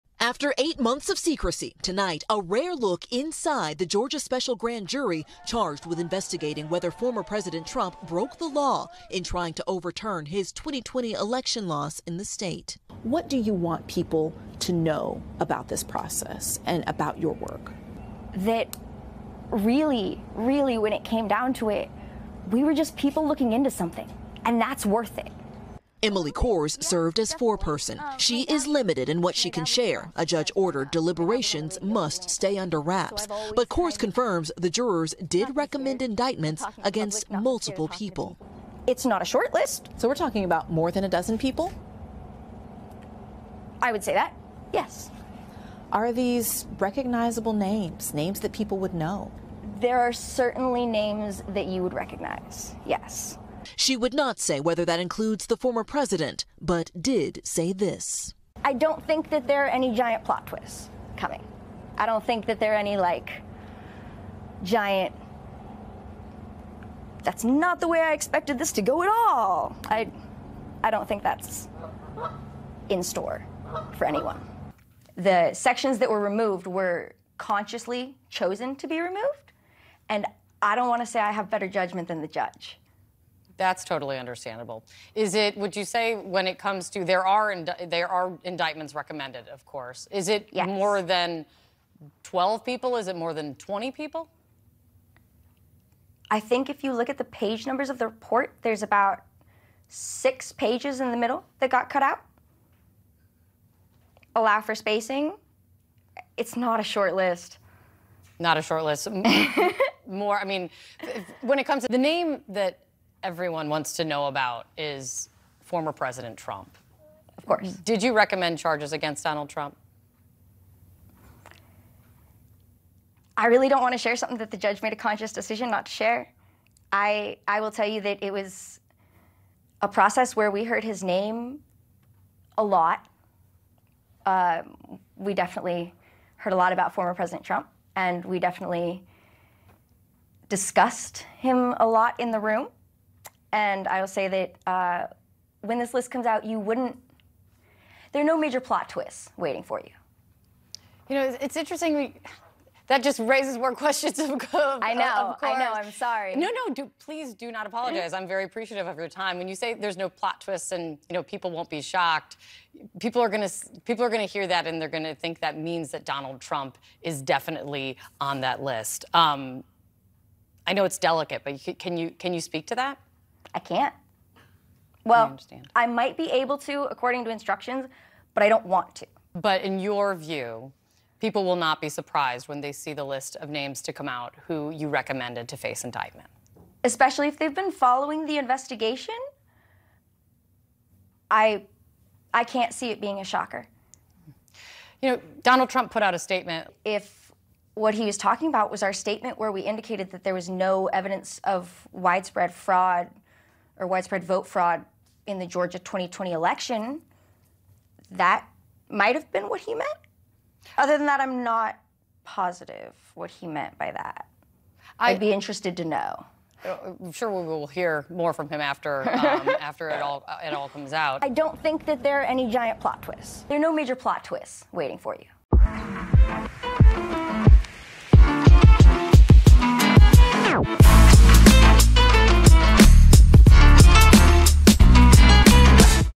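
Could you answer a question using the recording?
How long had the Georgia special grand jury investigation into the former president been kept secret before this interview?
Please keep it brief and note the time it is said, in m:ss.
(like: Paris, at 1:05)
8 months, at 0:00.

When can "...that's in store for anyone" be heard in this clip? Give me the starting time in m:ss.
1:11.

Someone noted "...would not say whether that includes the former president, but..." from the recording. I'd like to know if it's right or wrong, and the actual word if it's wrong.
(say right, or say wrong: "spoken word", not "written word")
right.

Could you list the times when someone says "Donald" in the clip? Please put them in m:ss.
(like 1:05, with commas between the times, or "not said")
1:59, 2:46, 3:15.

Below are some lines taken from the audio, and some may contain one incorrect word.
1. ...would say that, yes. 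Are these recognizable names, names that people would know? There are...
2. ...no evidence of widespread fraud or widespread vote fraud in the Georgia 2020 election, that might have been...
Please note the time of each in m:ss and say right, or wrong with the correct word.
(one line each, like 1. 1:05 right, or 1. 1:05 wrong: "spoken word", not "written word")
1. 0:43 right
2. 3:20 right.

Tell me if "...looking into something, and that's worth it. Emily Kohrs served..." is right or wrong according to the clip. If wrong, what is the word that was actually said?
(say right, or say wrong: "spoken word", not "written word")
right.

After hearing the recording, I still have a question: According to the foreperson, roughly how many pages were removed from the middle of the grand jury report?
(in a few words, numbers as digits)
6.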